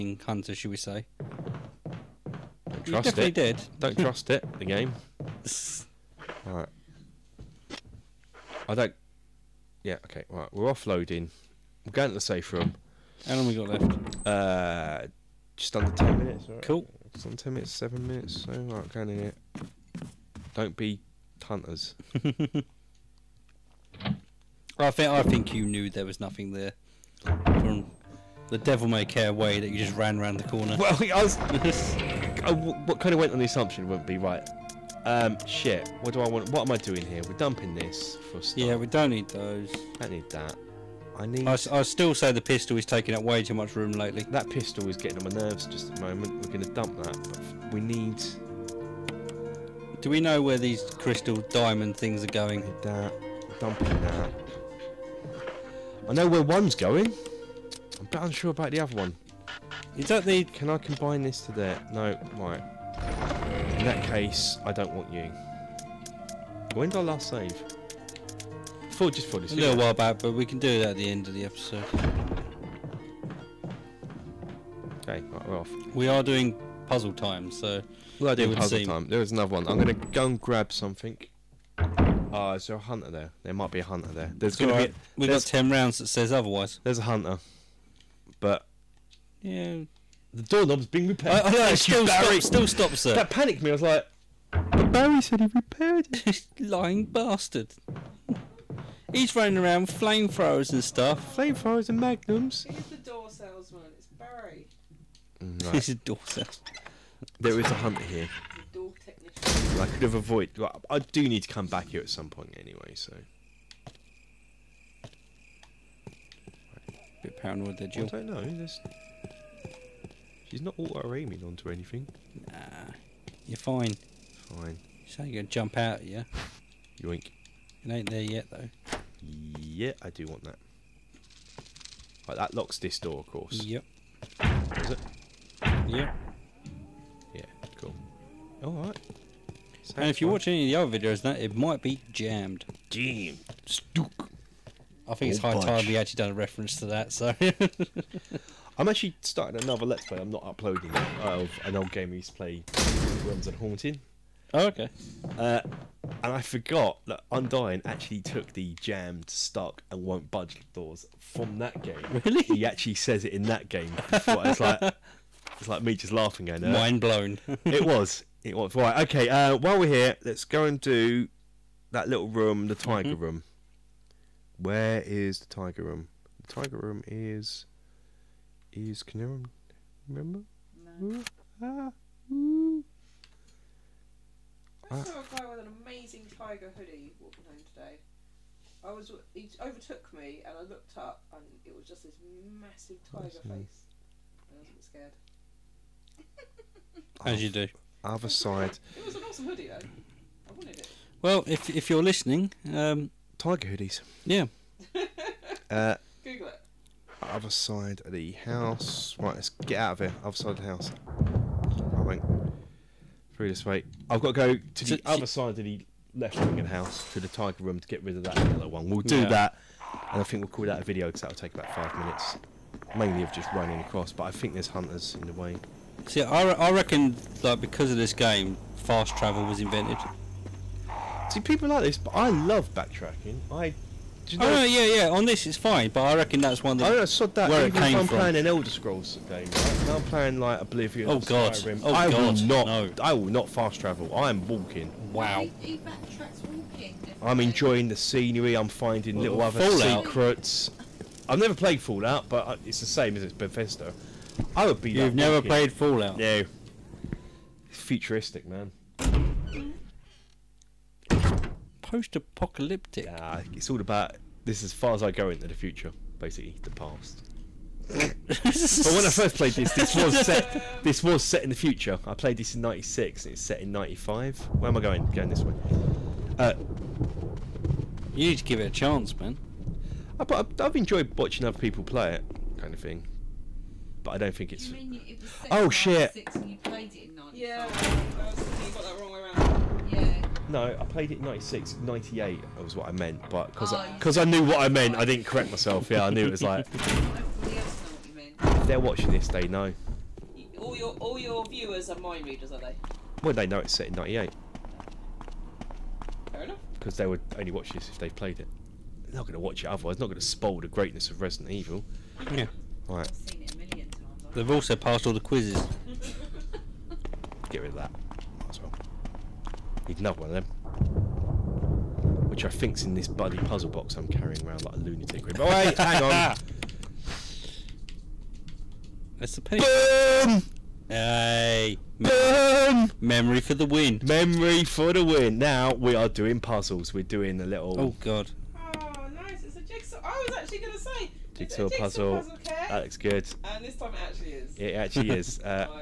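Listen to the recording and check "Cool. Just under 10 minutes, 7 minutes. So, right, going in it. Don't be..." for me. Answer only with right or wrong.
right.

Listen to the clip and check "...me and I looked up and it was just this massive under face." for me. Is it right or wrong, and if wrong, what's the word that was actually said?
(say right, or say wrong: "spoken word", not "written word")
wrong: "tiger", not "under".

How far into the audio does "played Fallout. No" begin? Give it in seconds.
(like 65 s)
255 s.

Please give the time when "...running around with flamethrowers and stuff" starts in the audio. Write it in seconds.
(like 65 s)
99 s.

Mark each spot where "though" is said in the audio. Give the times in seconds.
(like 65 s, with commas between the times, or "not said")
128 s, 199 s.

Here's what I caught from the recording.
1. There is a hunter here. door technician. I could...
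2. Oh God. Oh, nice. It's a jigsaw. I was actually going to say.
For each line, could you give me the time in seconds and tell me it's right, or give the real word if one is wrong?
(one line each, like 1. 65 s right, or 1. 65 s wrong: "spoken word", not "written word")
1. 107 s right
2. 337 s right.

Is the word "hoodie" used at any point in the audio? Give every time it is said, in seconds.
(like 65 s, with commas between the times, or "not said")
186 s, 199 s, 203 s.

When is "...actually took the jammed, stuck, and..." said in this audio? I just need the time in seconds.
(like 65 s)
157 s.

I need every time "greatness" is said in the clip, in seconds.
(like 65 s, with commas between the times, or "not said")
310 s.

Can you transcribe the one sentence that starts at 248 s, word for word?
I'm finding well, little other Fallout.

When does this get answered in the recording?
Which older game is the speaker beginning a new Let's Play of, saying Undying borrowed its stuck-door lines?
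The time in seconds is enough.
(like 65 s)
153 s.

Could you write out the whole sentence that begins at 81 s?
Ah, uh, is there a hunter there?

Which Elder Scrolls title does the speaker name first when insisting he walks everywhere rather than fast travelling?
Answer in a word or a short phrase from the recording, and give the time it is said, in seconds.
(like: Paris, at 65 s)
Oblivion, at 240 s.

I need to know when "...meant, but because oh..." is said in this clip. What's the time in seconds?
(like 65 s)
292 s.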